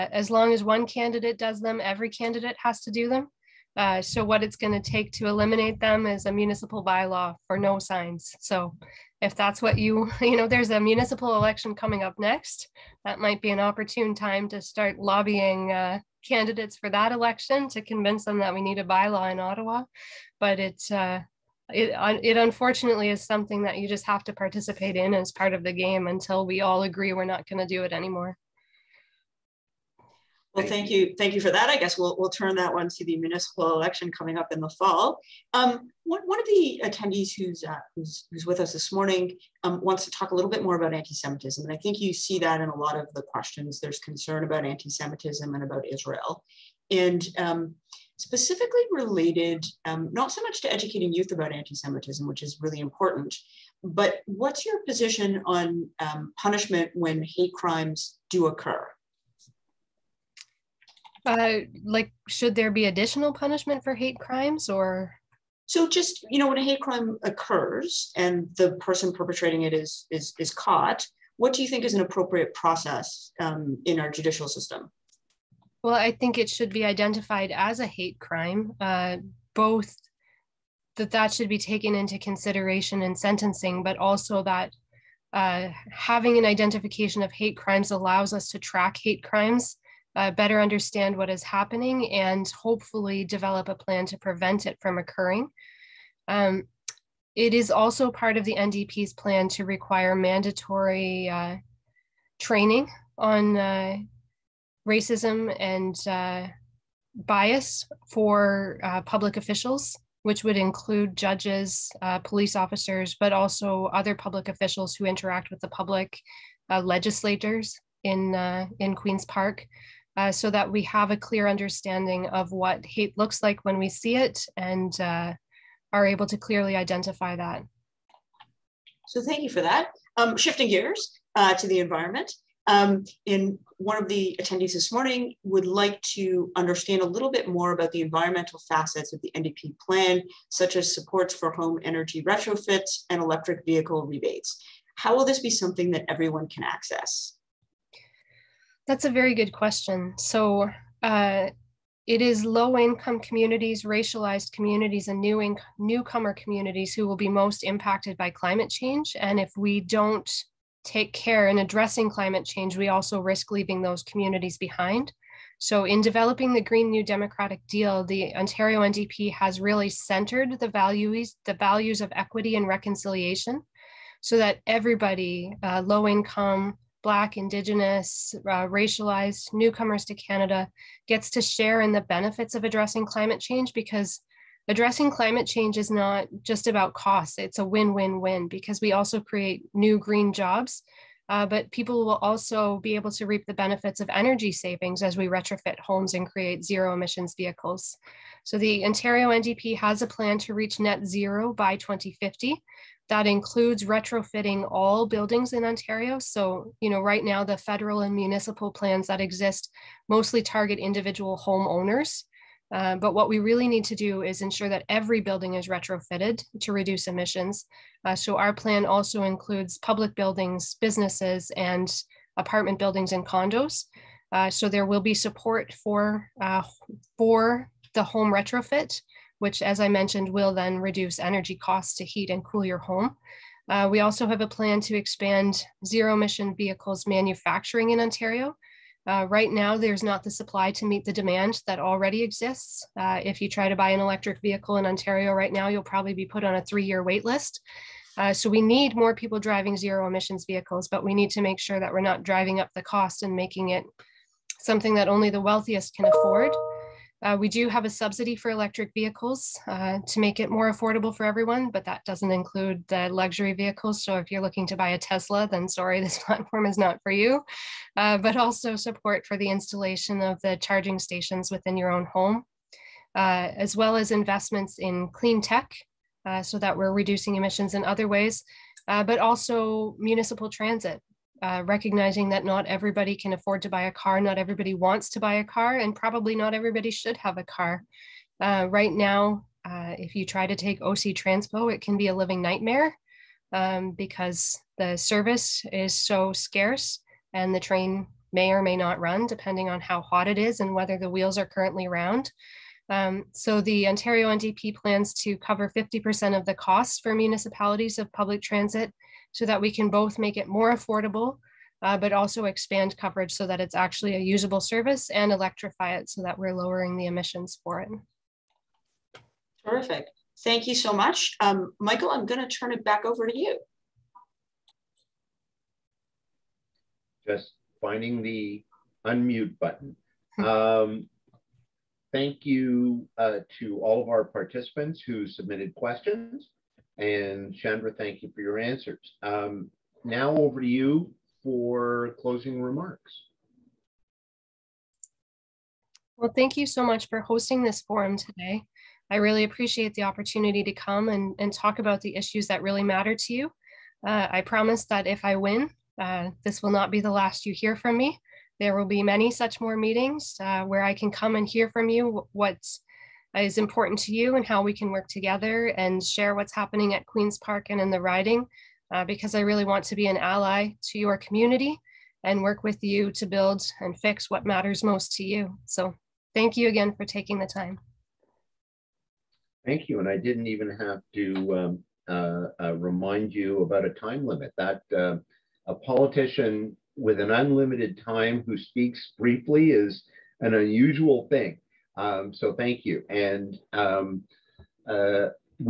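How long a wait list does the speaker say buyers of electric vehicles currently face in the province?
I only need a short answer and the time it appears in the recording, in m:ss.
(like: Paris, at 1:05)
3 years, at 4:06.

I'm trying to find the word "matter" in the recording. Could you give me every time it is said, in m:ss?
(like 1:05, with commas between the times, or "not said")
5:52, 6:14.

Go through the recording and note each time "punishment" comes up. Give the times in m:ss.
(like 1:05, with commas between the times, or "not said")
0:56, 1:03.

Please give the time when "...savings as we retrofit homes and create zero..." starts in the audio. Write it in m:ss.
3:14.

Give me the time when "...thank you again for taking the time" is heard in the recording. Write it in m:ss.
6:16.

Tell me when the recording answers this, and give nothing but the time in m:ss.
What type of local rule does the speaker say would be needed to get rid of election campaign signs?
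0:06.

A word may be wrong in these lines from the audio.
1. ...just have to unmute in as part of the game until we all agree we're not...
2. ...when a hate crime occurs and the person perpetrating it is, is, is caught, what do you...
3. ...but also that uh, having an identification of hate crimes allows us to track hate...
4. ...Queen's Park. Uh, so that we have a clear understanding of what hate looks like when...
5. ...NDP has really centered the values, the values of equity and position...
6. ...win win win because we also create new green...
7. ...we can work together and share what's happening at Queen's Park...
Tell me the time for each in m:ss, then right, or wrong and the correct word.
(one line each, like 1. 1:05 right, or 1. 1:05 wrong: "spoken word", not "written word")
1. 0:23 wrong: "participate", not "unmute"
2. 1:06 right
3. 1:23 right
4. 1:58 right
5. 2:48 wrong: "reconciliation", not "position"
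6. 3:07 right
7. 6:04 right.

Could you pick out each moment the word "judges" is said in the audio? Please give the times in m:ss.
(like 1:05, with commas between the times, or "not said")
1:51.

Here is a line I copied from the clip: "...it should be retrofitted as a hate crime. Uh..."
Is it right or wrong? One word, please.
wrong.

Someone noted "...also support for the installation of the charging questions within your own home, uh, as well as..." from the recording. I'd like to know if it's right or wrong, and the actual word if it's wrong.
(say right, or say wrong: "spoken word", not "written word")
wrong: "stations", not "questions".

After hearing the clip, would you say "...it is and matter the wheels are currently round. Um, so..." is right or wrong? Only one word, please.
wrong.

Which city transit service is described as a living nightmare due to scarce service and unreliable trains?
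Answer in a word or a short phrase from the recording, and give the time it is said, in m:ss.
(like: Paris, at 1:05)
OC Transpo, at 4:50.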